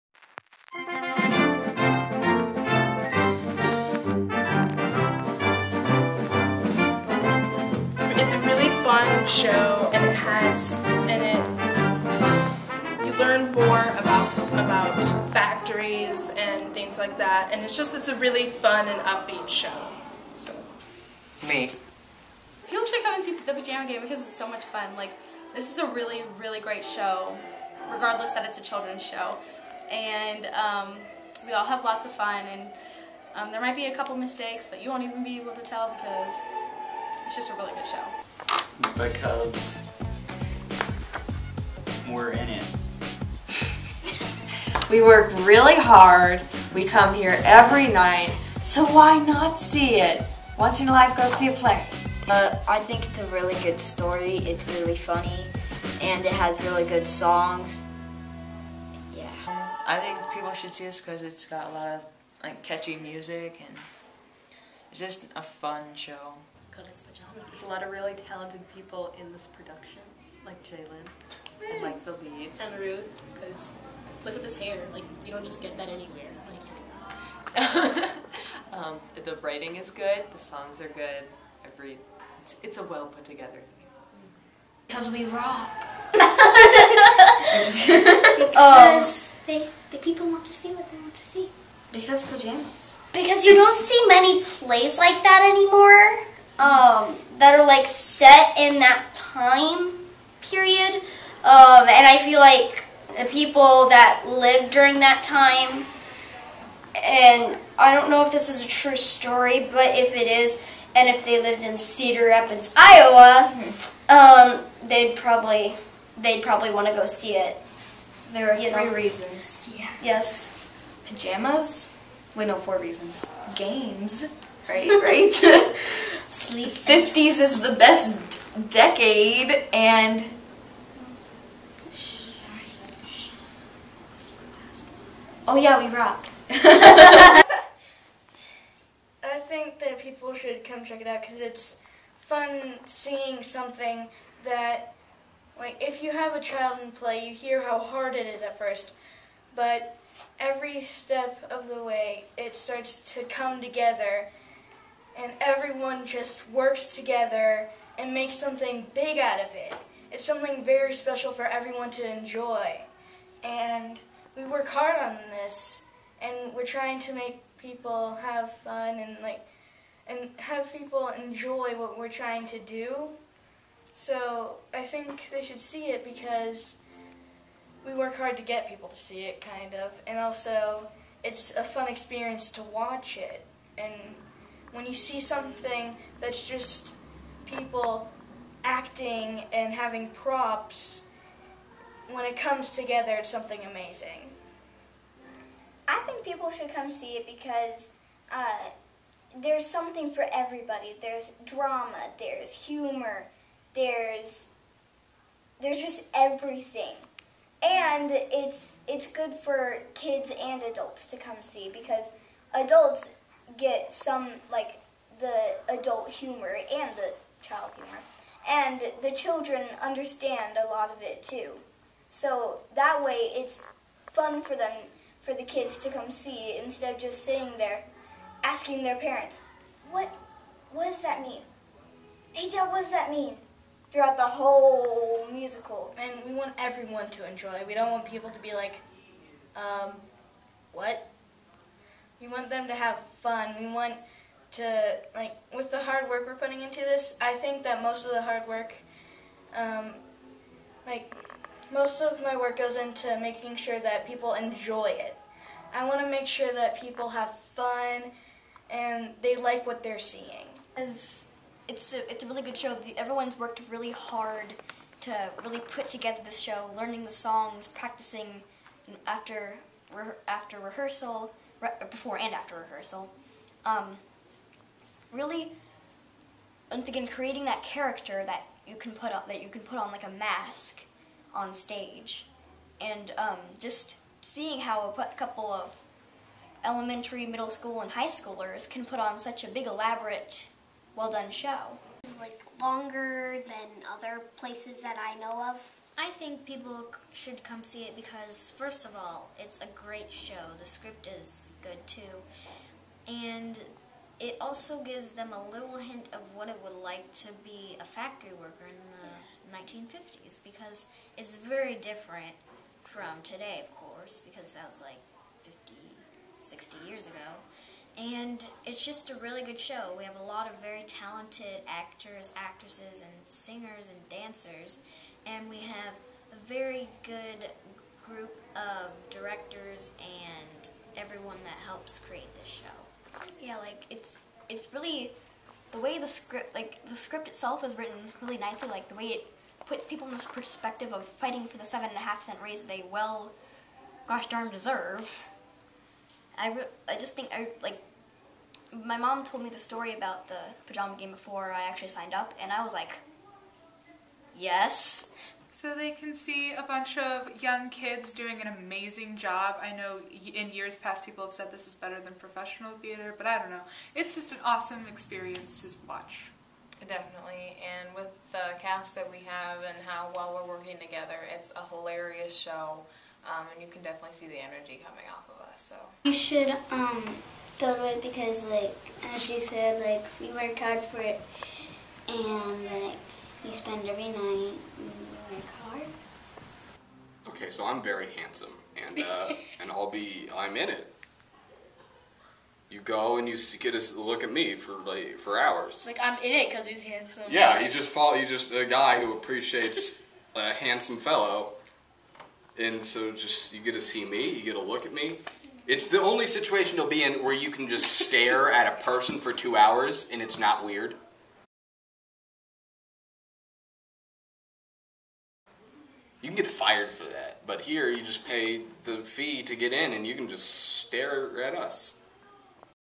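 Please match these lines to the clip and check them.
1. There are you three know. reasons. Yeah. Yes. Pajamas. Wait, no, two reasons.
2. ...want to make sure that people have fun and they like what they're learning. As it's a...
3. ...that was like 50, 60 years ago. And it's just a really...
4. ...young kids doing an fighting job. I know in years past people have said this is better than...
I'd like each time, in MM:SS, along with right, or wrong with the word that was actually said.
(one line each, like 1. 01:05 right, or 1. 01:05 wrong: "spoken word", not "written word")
1. 01:58 wrong: "four", not "two"
2. 04:15 wrong: "seeing", not "learning"
3. 05:14 right
4. 05:57 wrong: "amazing", not "fighting".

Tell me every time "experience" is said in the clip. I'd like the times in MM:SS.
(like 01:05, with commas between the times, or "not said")
03:01, 06:04.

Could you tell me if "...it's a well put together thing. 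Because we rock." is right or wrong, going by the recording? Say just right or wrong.
right.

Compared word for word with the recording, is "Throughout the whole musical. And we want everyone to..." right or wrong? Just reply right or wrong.
right.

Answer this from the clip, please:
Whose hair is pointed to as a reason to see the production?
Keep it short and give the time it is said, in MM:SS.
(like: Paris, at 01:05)
Ruth, at 01:12.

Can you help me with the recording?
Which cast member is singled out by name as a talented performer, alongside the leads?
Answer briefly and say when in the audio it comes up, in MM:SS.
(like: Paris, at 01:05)
Jalen, at 01:10.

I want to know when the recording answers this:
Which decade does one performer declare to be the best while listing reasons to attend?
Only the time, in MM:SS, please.
02:06.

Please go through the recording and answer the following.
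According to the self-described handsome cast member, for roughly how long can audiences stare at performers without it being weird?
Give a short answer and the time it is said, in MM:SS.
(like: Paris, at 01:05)
2 hours, at 06:49.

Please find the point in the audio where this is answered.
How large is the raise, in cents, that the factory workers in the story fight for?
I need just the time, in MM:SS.
05:41.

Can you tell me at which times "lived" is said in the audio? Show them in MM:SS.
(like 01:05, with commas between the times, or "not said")
01:44, 01:51.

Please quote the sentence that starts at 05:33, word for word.
Yeah, like it's it's really the way the script like the script itself is written really nicely.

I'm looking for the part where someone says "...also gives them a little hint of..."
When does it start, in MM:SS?
05:04.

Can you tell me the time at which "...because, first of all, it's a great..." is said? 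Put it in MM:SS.
04:57.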